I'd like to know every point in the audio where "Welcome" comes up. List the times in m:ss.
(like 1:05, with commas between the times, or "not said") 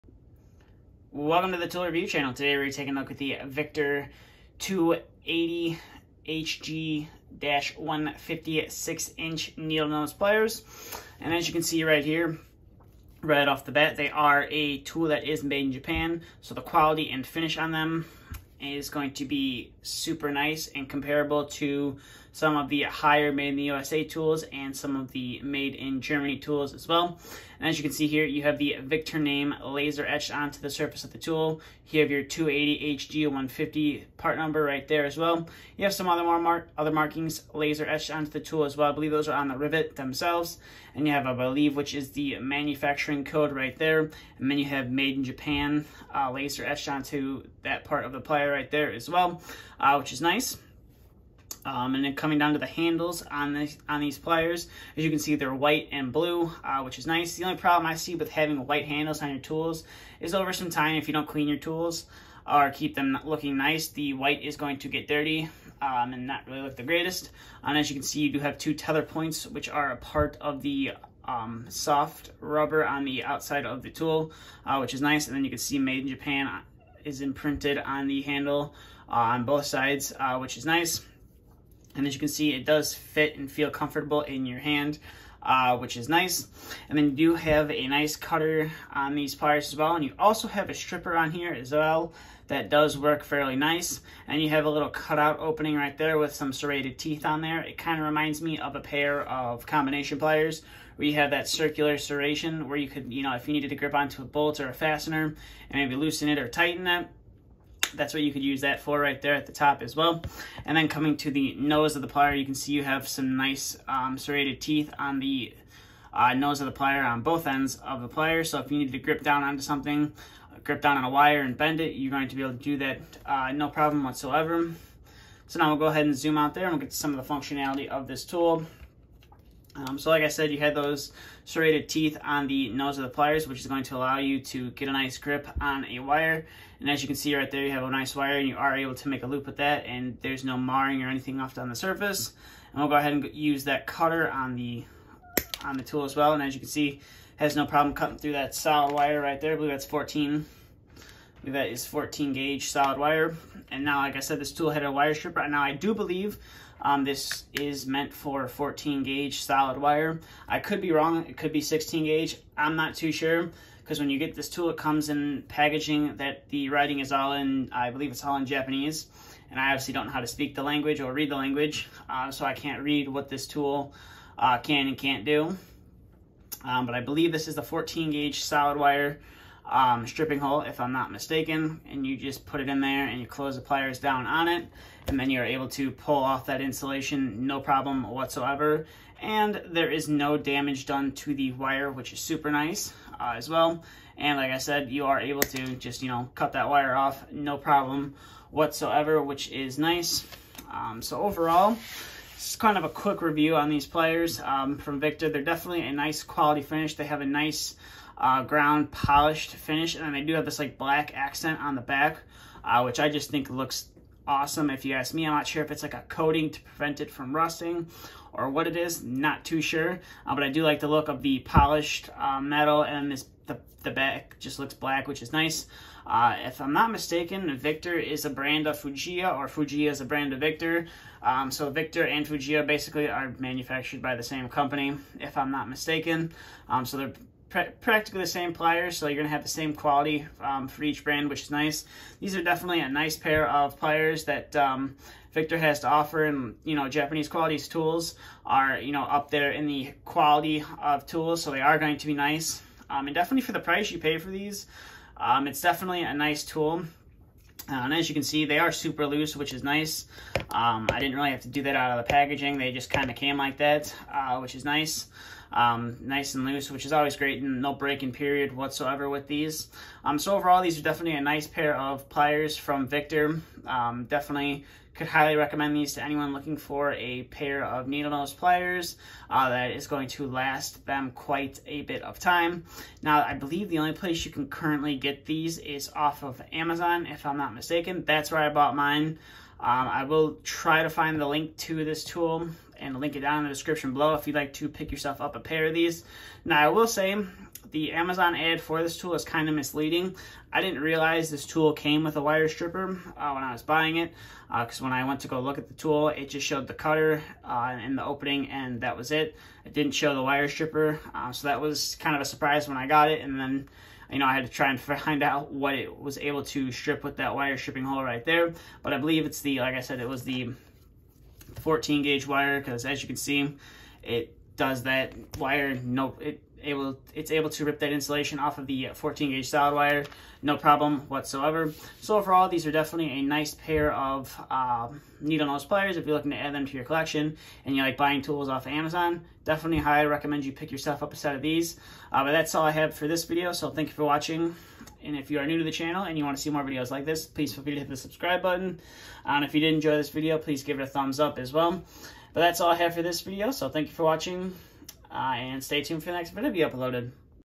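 0:01.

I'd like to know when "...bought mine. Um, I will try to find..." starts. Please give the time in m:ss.
4:48.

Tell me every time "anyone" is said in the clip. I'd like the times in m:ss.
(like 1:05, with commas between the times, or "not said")
4:36.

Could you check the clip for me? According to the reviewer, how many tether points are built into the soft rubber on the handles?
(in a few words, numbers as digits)
2.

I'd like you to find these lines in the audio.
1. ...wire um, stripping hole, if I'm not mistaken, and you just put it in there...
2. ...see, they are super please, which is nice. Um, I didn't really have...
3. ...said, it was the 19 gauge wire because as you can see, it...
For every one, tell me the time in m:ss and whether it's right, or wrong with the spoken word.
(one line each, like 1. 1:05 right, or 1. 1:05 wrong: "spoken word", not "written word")
1. 2:58 right
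2. 4:18 wrong: "loose", not "please"
3. 5:19 wrong: "14", not "19".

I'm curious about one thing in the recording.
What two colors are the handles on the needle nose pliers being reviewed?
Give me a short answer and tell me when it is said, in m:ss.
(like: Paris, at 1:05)
White and blue, at 0:55.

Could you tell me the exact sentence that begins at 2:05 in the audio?
So now we'll go ahead and zoom out there and we'll get to some of the functionality of this tool.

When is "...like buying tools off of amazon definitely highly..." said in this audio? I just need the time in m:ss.
5:37.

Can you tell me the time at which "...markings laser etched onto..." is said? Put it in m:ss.
0:36.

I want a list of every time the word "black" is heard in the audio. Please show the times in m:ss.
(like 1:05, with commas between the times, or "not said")
3:30, 3:44.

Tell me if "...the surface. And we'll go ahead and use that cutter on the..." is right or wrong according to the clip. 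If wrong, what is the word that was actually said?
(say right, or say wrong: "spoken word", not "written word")
right.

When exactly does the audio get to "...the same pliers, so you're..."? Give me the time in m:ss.
3:58.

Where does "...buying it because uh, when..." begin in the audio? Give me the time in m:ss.
5:03.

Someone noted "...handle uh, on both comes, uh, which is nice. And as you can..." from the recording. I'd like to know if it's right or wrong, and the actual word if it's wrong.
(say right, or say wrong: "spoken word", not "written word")
wrong: "sides", not "comes".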